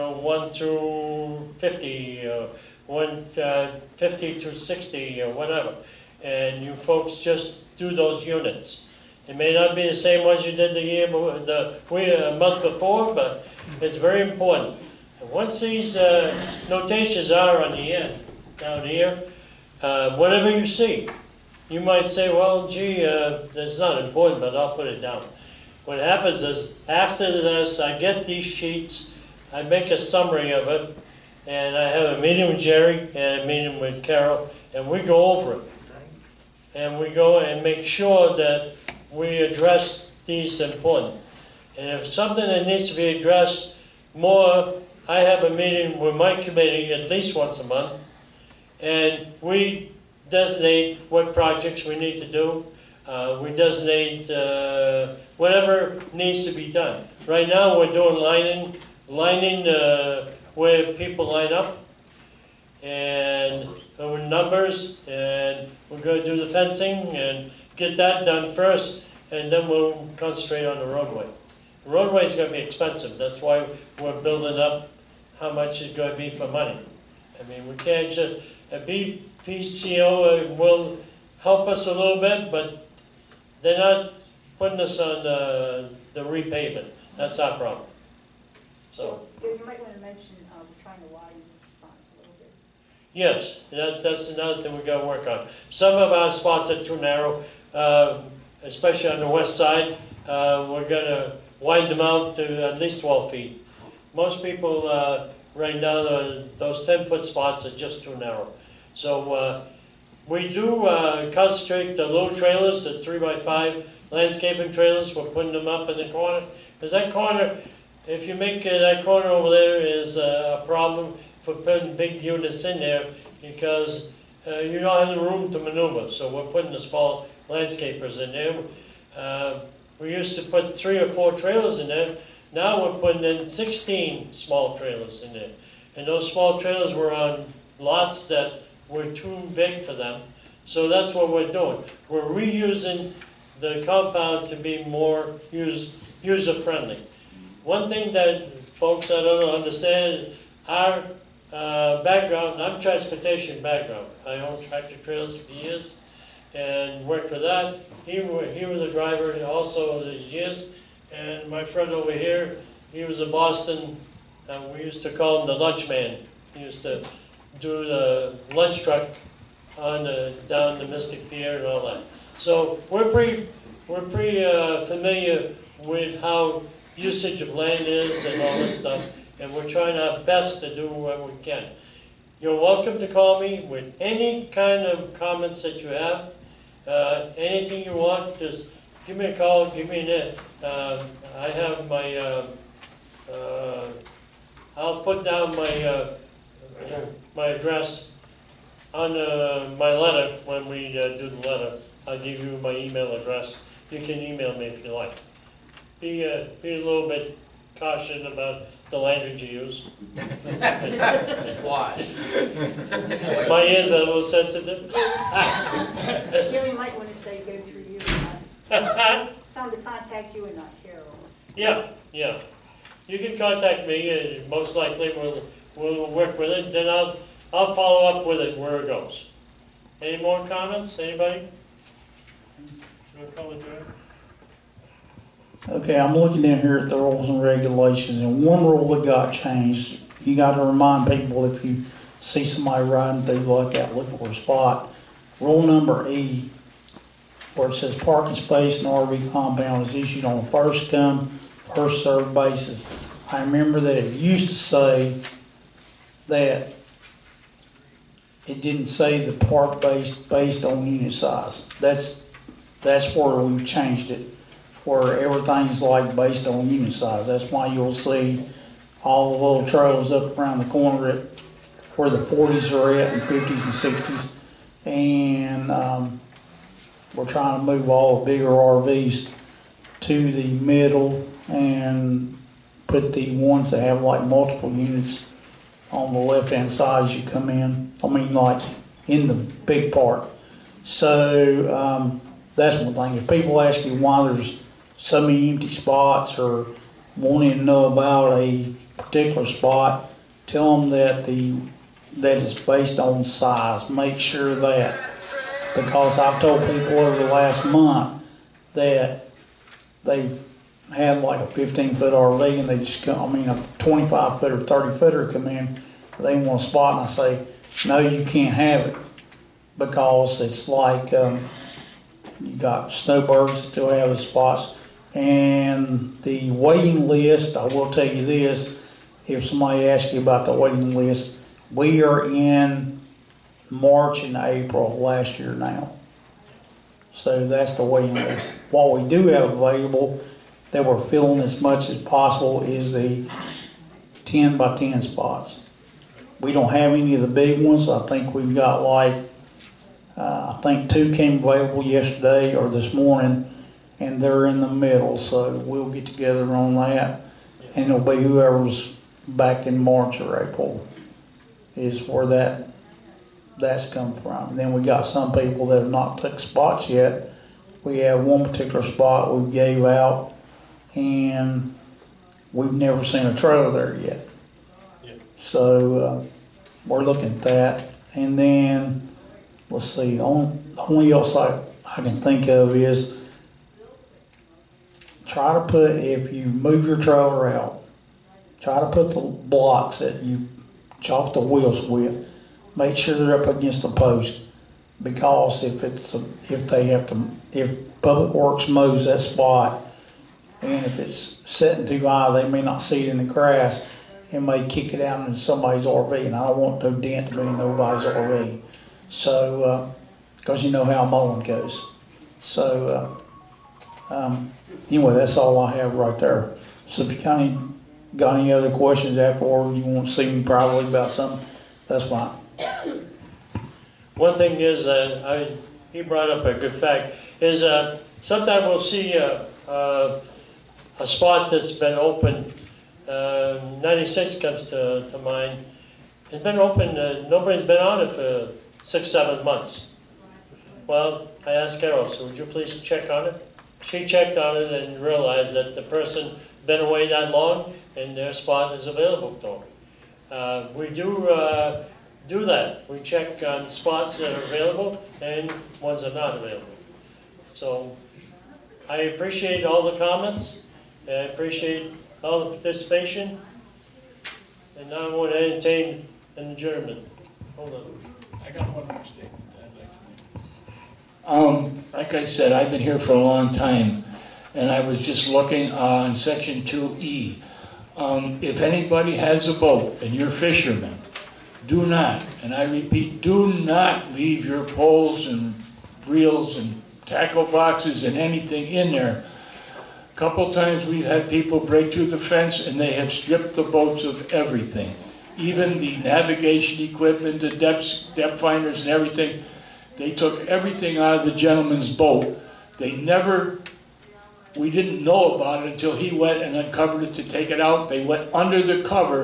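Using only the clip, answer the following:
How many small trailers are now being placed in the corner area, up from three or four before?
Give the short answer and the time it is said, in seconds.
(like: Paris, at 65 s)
16, at 133 s.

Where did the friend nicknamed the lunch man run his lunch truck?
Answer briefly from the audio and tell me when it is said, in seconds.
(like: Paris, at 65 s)
Mystic Pier, at 170 s.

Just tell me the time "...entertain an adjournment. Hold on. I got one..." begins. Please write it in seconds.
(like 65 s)
465 s.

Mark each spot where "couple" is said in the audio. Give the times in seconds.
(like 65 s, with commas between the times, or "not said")
490 s.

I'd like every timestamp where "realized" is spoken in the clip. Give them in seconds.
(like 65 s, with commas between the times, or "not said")
445 s.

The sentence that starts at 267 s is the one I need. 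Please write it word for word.
That's why you'll see all the little trailers up around the corner at where the forties are at and fifties and sixties.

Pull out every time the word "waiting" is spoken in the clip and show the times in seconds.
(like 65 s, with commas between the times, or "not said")
326 s, 330 s, 337 s.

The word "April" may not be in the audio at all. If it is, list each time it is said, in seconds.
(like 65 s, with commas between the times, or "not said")
334 s, 360 s.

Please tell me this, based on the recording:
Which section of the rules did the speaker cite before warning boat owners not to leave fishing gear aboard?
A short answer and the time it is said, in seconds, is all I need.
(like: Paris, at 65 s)
2E, at 476 s.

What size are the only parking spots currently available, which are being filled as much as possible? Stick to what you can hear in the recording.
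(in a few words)
10 by 10.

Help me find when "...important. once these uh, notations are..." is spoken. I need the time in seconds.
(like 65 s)
14 s.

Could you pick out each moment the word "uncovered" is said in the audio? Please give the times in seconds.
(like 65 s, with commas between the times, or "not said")
506 s.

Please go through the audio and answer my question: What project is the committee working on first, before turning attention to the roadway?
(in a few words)
fencing.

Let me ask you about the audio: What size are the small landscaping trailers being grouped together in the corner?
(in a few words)
3x5.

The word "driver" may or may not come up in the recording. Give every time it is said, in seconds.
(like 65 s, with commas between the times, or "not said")
158 s.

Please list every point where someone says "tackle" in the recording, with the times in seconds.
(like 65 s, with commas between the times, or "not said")
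487 s.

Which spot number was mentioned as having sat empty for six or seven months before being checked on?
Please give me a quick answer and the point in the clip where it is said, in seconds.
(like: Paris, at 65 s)
96, at 433 s.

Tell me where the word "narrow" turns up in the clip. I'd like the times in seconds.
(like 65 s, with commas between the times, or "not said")
96 s, 108 s.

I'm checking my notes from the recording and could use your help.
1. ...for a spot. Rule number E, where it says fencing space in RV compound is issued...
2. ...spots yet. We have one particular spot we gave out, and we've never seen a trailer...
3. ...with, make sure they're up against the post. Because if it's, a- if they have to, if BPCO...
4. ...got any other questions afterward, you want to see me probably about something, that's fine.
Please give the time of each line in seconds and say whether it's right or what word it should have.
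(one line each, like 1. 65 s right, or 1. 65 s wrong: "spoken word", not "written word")
1. 244 s wrong: "parking", not "fencing"
2. 366 s right
3. 391 s wrong: "Public", not "BPCO"
4. 418 s right.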